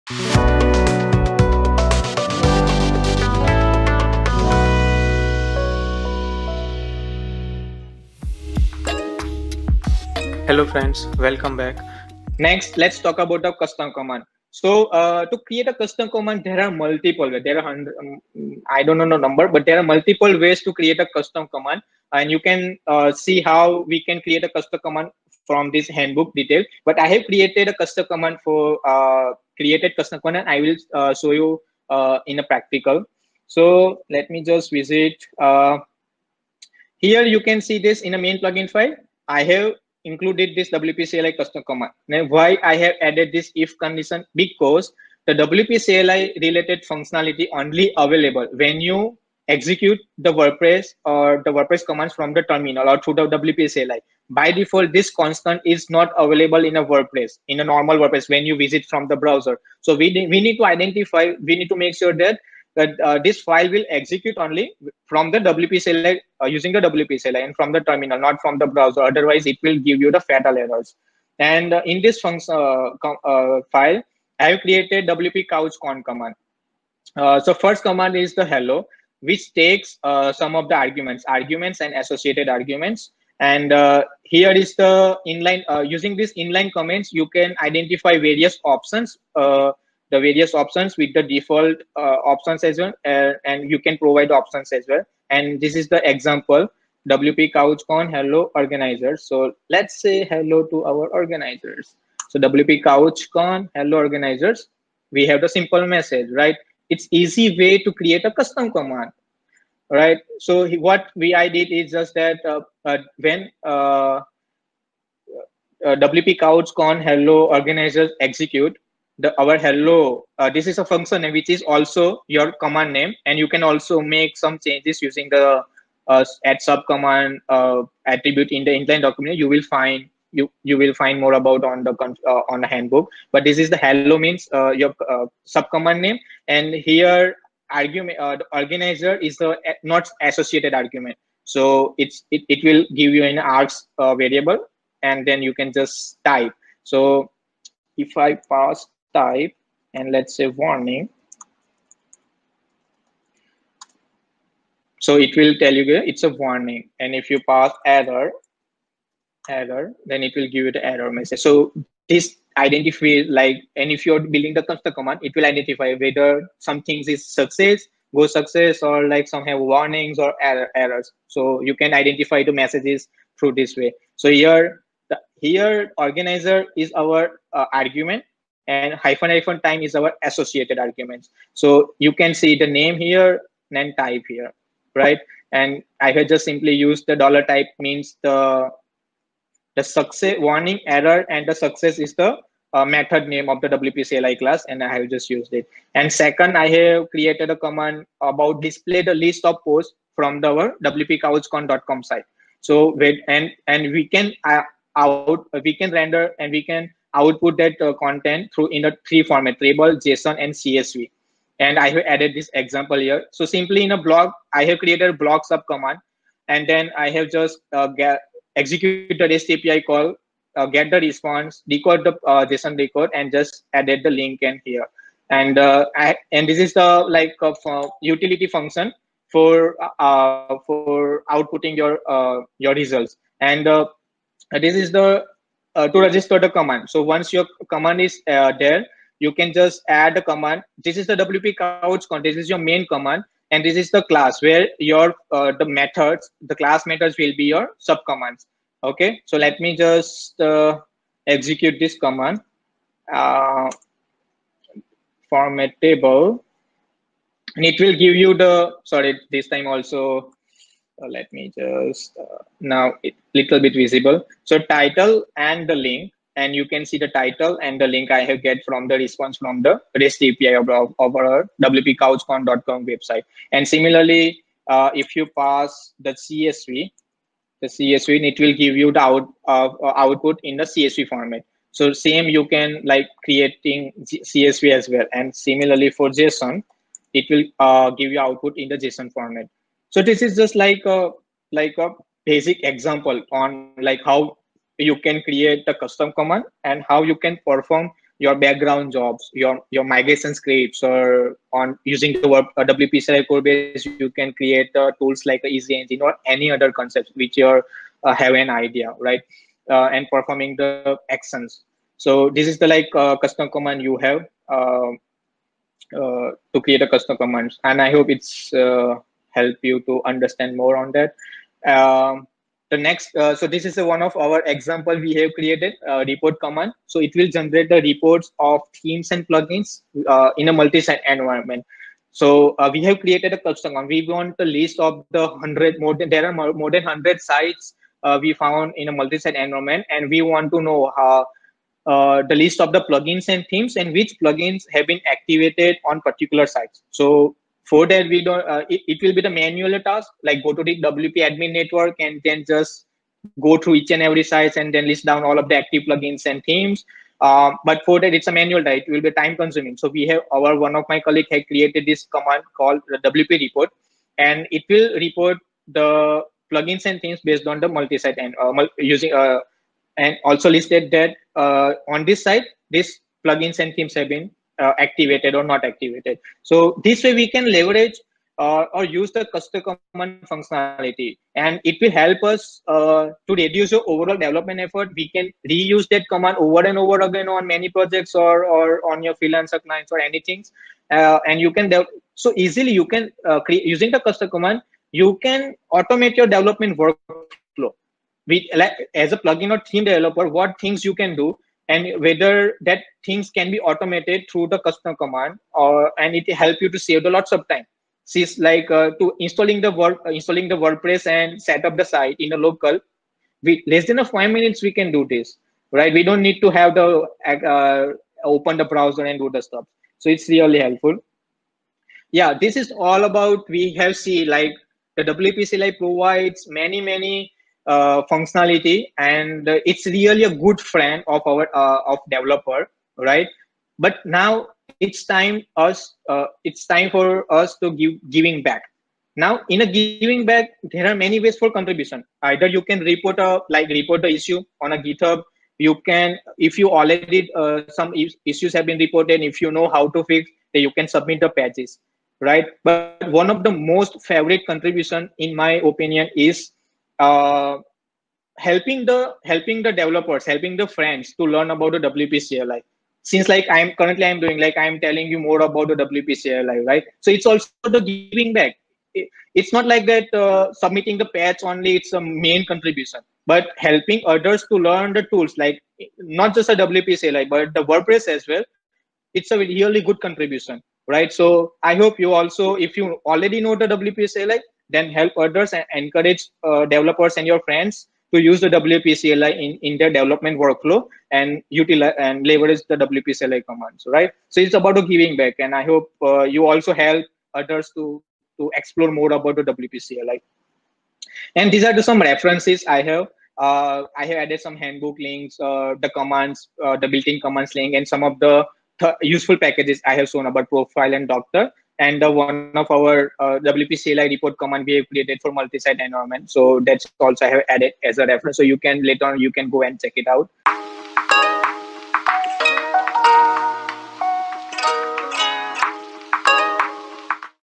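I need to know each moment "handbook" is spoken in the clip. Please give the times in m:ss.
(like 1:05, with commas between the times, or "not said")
0:25, 2:12, 8:24.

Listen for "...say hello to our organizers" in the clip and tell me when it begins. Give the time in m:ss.
1:40.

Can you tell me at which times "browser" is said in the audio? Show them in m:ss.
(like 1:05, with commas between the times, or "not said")
0:59, 1:08, 6:58.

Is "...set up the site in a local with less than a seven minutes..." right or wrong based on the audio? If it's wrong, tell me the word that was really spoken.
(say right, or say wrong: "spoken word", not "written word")
wrong: "five", not "seven".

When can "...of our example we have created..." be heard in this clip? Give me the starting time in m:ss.
5:24.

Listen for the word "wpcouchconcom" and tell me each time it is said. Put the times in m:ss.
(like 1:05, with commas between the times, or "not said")
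3:20, 4:31.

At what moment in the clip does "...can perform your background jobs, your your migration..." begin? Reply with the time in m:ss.
4:57.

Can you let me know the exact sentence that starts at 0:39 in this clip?
I have included this WPCLI custom command.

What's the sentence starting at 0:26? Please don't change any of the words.
But I have created a custom command for uh, created custom command.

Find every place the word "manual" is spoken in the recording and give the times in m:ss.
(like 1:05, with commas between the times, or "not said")
5:49, 5:58.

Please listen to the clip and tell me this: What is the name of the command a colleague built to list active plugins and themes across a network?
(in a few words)
wp report.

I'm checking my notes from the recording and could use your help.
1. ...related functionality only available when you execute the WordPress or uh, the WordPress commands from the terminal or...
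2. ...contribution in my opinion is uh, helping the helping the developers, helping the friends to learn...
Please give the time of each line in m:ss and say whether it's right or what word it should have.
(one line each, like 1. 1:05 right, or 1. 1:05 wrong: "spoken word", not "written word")
1. 0:46 right
2. 7:34 right.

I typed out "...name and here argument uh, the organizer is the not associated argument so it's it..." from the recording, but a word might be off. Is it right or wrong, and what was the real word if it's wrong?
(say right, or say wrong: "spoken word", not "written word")
right.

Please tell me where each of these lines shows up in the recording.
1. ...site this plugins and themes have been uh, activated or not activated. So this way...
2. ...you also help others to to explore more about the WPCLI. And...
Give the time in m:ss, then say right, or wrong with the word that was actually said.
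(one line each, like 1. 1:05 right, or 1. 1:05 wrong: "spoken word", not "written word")
1. 6:12 right
2. 8:16 right.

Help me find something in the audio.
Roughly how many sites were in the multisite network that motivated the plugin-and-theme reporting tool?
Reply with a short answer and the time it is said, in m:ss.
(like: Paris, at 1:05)
more than 100, at 5:36.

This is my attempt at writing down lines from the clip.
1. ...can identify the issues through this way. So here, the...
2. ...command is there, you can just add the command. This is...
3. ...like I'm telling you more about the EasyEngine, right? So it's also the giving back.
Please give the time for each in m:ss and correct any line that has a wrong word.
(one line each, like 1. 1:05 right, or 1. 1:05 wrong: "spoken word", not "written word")
1. 2:51 wrong: "messages", not "issues"
2. 3:57 right
3. 7:44 wrong: "WPCL", not "EasyEngine".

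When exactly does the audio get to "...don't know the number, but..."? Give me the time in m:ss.
0:18.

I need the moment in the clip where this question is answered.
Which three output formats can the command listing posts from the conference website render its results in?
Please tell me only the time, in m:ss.
3:29.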